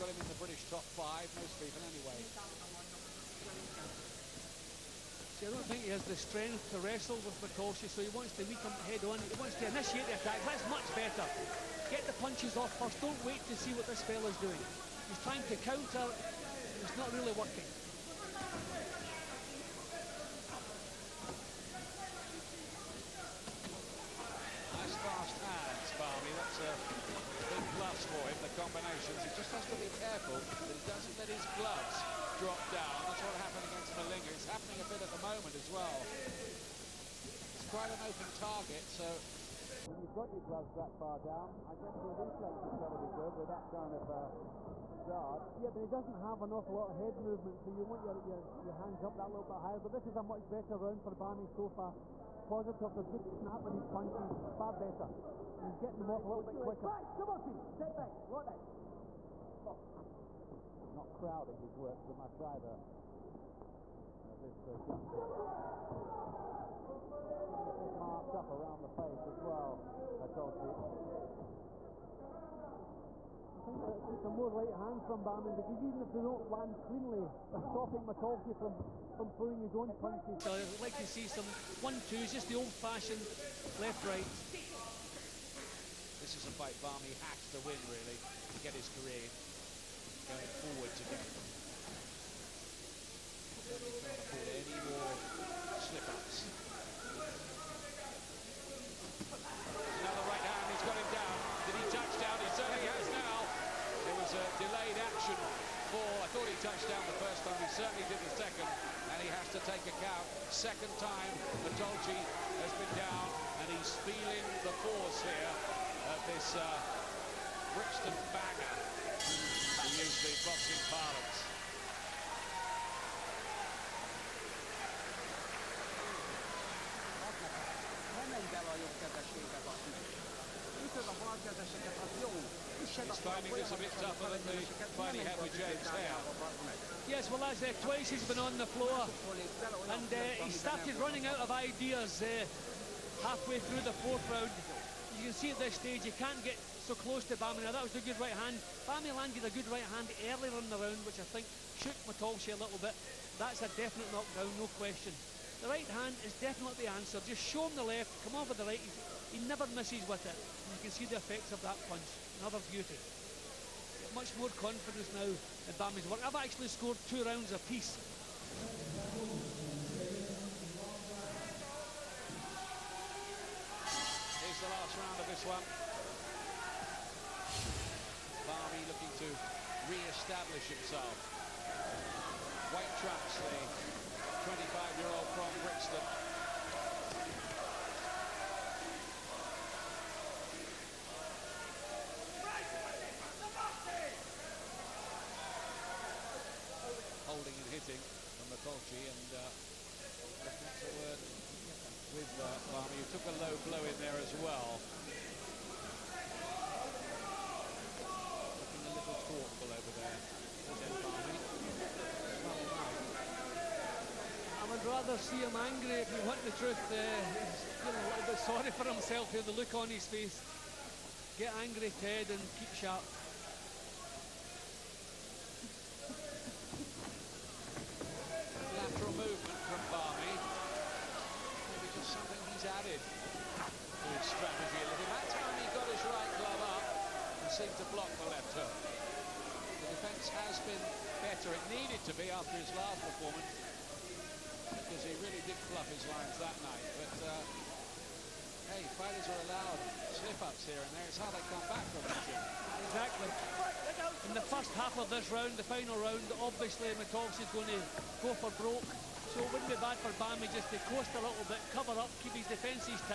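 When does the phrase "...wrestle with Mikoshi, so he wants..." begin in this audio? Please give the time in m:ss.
0:06.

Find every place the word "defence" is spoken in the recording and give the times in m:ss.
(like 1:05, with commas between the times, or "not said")
3:59, 4:22.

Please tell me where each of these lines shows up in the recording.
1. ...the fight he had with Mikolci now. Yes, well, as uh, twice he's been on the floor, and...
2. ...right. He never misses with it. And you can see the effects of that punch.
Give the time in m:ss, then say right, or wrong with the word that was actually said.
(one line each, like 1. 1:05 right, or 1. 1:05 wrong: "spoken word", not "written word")
1. 2:14 wrong: "James", not "Mikolci"
2. 2:38 right.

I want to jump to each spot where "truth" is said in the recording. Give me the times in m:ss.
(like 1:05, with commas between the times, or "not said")
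3:36.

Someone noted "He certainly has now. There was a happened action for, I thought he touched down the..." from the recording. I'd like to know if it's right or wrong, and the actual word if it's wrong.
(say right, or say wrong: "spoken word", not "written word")
wrong: "delayed", not "happened".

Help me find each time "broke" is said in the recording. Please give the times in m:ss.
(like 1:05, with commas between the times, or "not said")
4:18.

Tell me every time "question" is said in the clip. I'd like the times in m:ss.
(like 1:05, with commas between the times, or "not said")
2:34.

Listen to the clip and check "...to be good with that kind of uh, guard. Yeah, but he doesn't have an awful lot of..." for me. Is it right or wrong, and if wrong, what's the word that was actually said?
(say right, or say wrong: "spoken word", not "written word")
right.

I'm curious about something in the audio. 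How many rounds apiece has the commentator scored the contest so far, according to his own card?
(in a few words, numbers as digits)
2.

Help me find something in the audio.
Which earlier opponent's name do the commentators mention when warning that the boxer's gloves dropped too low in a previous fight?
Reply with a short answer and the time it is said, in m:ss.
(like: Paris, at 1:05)
Malinga, at 0:33.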